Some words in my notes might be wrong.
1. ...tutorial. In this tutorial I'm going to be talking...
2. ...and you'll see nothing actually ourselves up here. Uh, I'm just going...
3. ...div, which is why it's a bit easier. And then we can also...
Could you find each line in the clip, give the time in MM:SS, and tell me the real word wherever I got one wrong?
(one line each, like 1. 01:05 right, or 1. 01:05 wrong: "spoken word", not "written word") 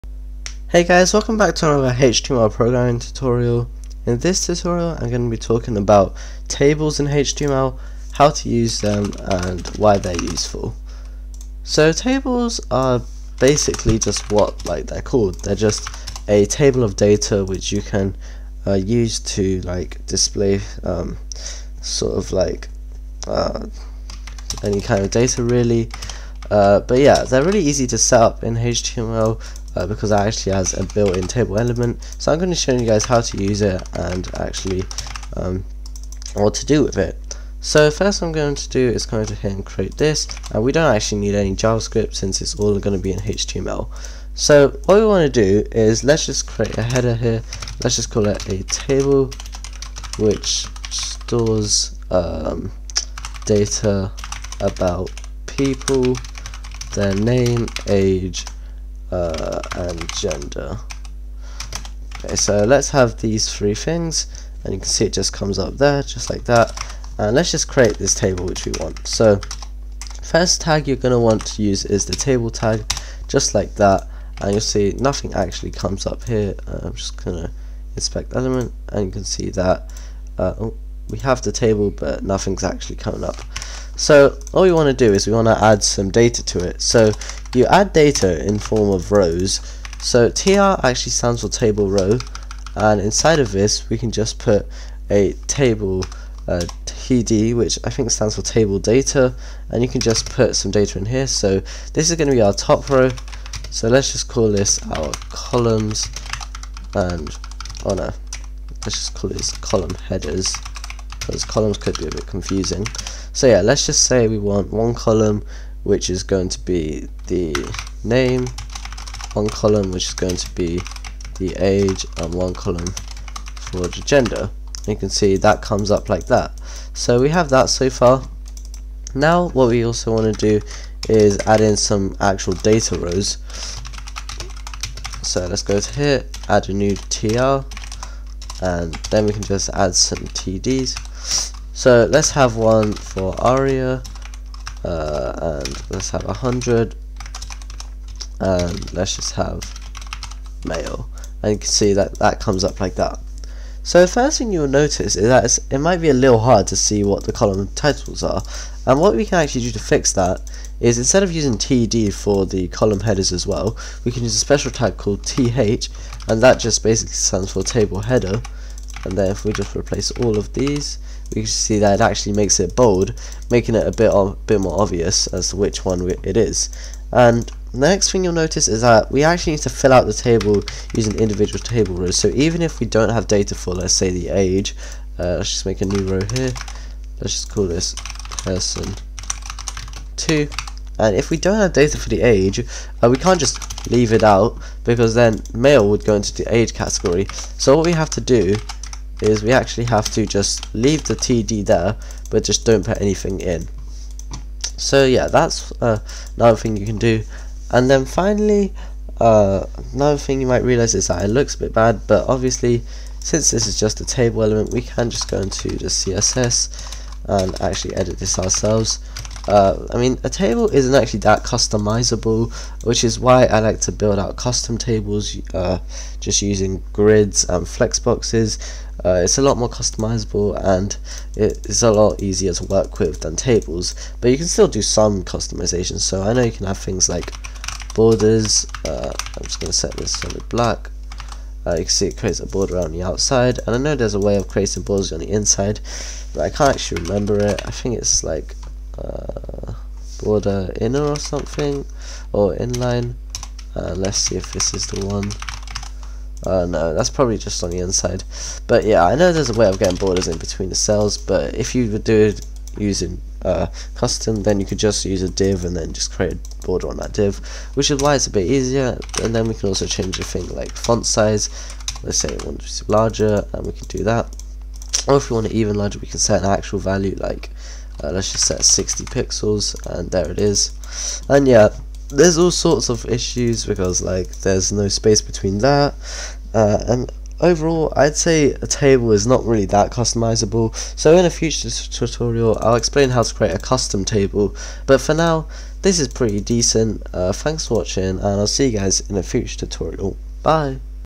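1. 00:02 right
2. 01:14 wrong: "comes", not "ourselves"
3. 04:27 right.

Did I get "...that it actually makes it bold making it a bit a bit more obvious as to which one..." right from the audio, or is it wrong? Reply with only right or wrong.
right.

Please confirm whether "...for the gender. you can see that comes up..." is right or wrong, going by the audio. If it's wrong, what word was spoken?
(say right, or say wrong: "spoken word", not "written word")
right.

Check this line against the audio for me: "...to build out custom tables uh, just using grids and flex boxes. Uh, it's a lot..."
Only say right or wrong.
right.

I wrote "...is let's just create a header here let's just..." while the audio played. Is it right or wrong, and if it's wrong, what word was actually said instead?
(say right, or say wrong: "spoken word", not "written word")
right.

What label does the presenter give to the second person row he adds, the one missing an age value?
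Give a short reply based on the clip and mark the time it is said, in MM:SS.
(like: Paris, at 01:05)
person 2, at 03:08.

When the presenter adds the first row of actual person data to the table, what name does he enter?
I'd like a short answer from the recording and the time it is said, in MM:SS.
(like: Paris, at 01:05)
Aryaa, at 02:23.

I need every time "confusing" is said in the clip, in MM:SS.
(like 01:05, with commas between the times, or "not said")
01:52.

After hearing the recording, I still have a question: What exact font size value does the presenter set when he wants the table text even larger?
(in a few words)
60 pixels.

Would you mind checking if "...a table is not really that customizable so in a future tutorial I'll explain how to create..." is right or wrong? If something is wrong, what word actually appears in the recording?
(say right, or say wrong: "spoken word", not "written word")
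right.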